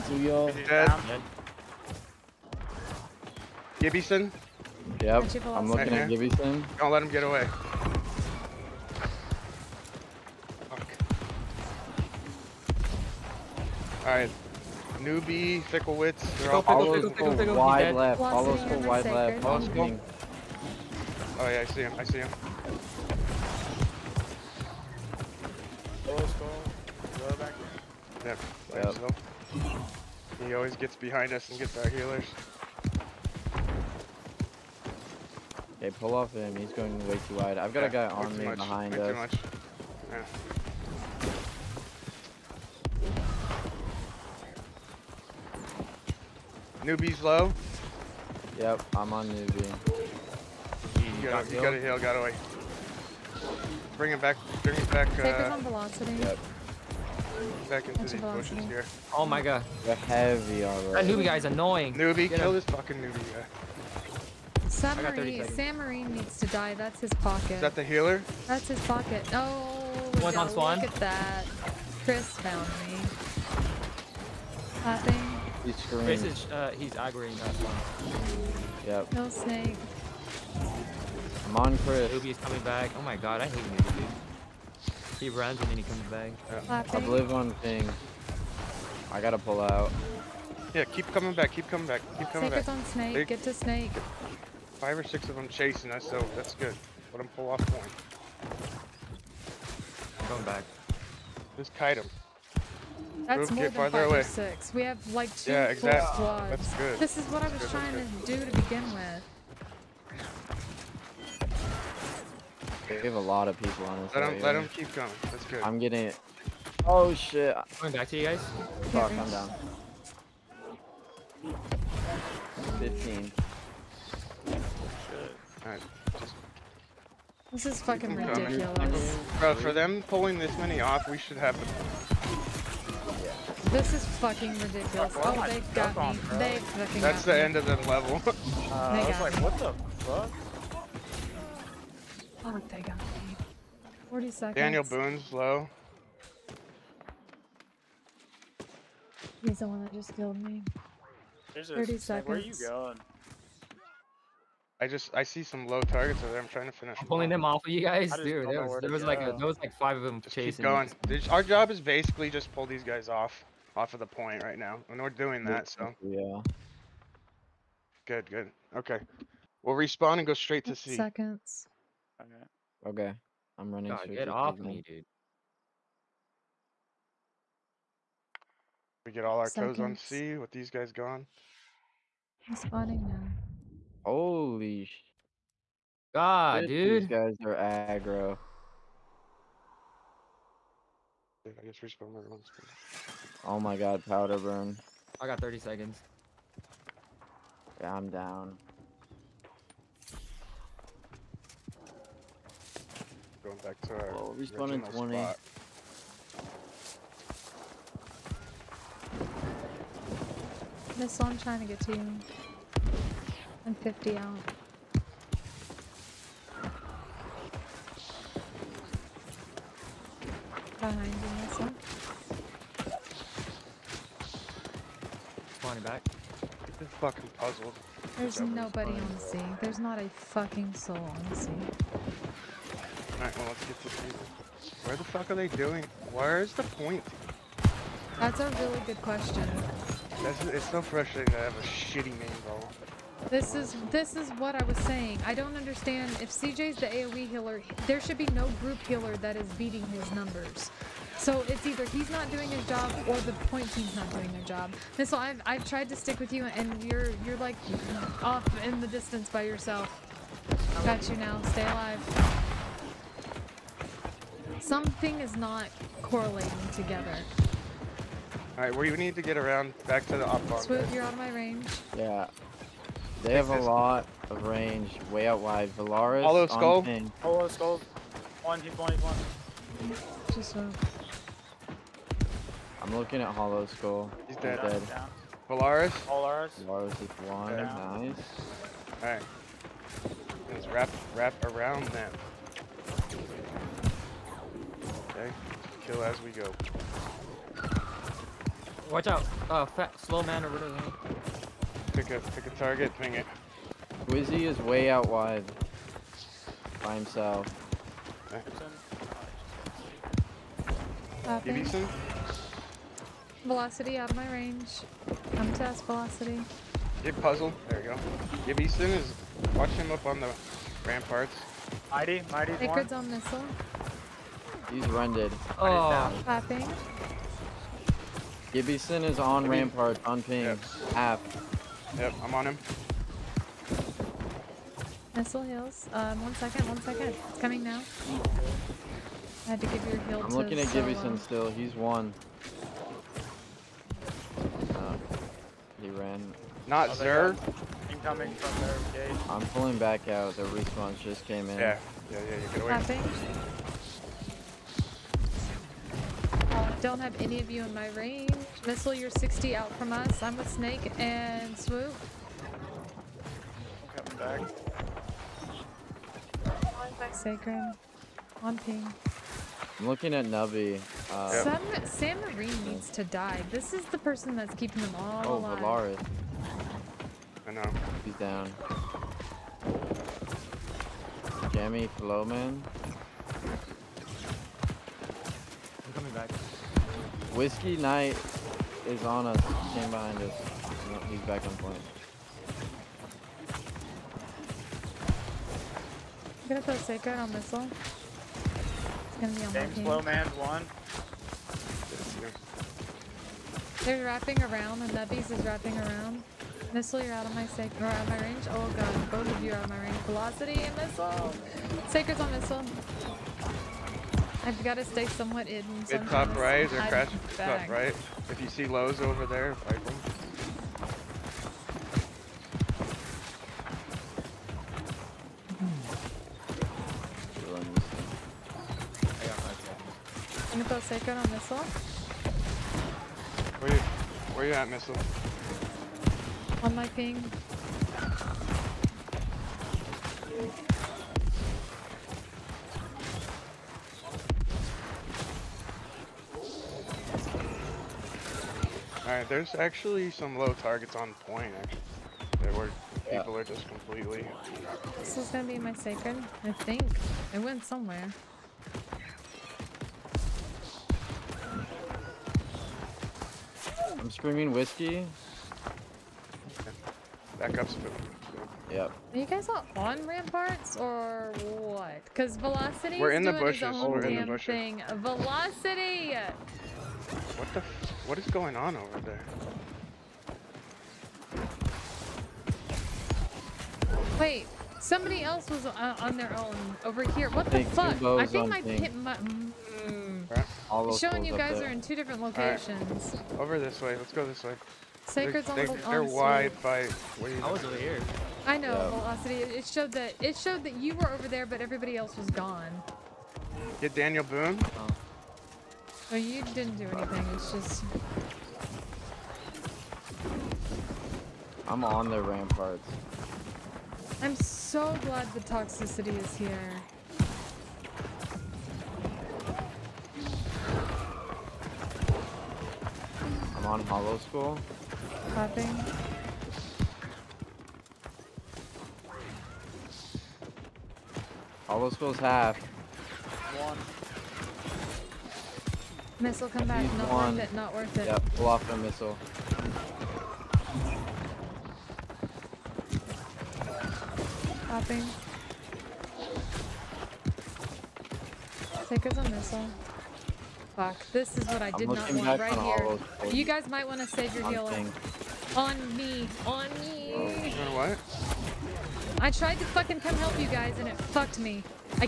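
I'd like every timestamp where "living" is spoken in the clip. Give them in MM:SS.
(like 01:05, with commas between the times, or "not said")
not said.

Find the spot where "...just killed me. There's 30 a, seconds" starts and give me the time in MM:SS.
02:29.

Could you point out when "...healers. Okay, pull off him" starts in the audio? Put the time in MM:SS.
00:31.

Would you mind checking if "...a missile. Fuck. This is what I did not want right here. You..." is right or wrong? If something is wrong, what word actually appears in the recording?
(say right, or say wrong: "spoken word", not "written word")
right.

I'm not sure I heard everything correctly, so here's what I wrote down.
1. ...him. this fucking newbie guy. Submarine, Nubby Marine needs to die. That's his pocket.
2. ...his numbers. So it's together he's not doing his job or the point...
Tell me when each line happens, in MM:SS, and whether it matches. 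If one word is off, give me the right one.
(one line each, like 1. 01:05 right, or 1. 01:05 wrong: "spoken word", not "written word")
1. 01:02 wrong: "Sam", not "Nubby"
2. 04:09 wrong: "either", not "together".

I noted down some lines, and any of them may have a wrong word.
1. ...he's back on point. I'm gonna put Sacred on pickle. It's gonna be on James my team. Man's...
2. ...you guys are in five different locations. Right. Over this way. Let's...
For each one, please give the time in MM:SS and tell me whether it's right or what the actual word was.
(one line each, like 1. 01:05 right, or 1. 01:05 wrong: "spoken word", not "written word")
1. 06:31 wrong: "missile", not "pickle"
2. 08:11 wrong: "two", not "five".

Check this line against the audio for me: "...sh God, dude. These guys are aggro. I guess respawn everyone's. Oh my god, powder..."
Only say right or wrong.
right.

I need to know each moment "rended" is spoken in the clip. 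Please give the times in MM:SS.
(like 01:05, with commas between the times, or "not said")
05:24.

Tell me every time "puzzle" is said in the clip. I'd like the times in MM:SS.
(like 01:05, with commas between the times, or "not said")
03:47, 05:17.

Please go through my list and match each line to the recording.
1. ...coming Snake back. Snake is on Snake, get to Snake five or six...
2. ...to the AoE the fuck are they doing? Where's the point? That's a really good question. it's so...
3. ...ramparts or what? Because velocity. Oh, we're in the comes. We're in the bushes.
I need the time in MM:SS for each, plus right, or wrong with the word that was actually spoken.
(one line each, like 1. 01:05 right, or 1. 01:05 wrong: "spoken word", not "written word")
1. 01:32 right
2. 03:53 wrong: "Where", not "AoE"
3. 07:50 wrong: "bushes", not "comes".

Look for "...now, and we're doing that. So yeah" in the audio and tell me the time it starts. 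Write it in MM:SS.
02:44.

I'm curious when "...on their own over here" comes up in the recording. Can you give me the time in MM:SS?
08:06.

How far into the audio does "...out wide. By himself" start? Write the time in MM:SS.
05:04.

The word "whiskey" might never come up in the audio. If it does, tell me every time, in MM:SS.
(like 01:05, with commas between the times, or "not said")
06:27, 07:44.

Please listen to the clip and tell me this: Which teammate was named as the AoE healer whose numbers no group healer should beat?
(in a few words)
CJ.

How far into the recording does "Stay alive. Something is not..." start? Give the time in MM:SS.
04:21.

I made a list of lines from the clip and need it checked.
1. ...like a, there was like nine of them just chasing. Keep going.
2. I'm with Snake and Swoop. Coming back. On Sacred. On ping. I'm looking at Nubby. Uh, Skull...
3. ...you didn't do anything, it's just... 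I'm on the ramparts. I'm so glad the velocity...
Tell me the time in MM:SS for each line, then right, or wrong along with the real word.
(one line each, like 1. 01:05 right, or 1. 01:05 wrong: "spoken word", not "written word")
1. 02:39 wrong: "five", not "nine"
2. 06:00 wrong: "Sam", not "Skull"
3. 08:26 wrong: "toxicity", not "velocity".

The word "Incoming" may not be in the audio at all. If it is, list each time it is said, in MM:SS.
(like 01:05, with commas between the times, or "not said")
05:47.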